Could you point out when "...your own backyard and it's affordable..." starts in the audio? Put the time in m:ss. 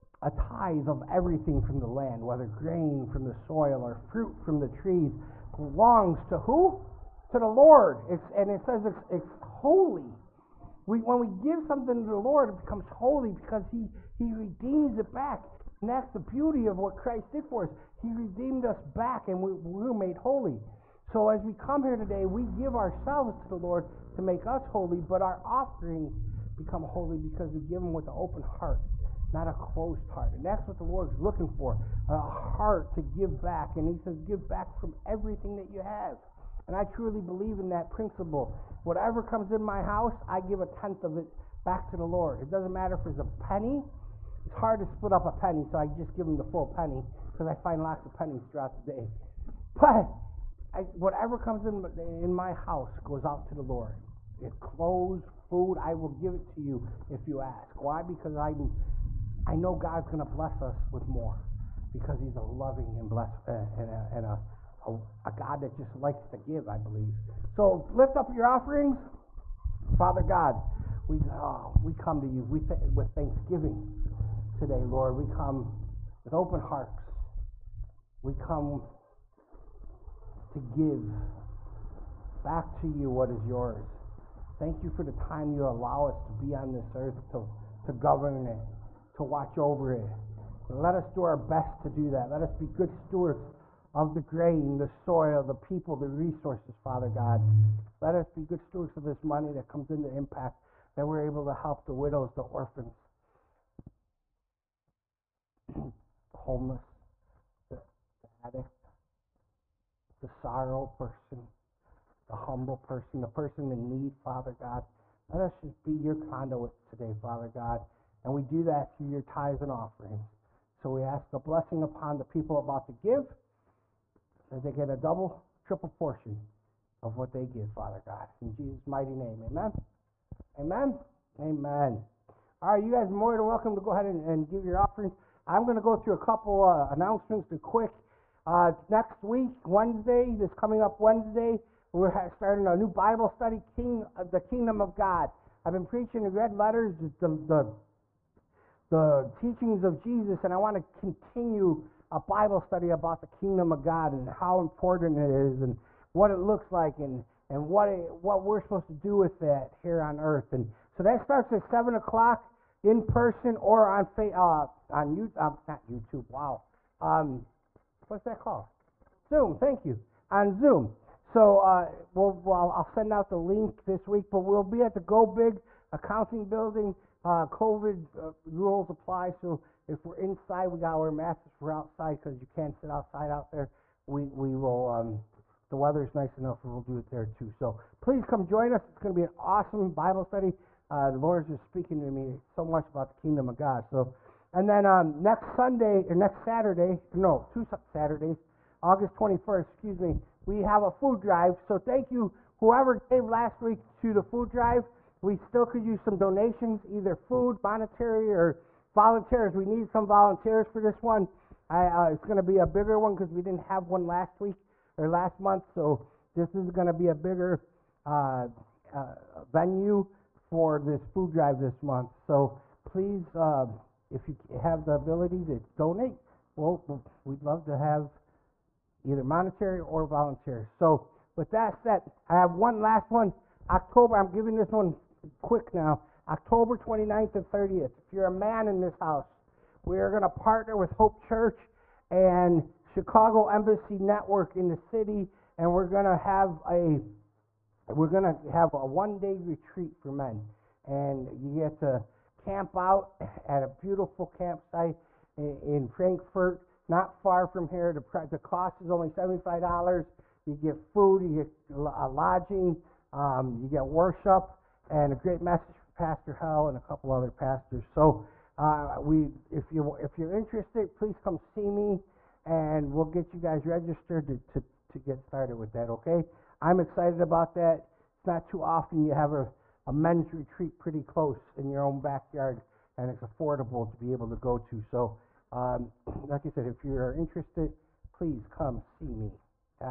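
4:41.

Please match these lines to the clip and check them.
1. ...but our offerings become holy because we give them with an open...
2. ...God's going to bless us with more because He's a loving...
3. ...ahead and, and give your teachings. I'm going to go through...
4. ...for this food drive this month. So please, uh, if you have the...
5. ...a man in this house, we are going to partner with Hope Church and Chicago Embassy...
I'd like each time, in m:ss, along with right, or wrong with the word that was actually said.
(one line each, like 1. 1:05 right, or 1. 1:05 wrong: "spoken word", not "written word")
1. 0:25 right
2. 0:59 right
3. 2:13 wrong: "offerings", not "teachings"
4. 3:40 right
5. 3:58 right.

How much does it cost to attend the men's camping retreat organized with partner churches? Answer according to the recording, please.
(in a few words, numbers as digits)
$75.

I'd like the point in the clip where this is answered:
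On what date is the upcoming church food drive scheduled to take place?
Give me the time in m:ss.
3:18.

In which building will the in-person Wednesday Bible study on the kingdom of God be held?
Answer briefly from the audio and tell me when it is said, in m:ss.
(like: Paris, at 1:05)
Go Big Accounting Building, at 2:55.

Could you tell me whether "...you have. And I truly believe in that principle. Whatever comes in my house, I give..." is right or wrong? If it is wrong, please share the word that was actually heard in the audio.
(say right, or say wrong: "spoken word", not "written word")
right.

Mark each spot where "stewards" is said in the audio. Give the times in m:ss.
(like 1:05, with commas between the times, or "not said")
1:32, 1:38.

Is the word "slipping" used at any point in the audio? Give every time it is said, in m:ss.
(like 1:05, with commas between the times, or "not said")
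not said.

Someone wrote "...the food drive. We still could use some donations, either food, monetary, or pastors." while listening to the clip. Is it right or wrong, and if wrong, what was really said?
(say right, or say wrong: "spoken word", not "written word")
wrong: "volunteers", not "pastors".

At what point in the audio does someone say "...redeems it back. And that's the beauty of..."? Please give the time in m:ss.
0:14.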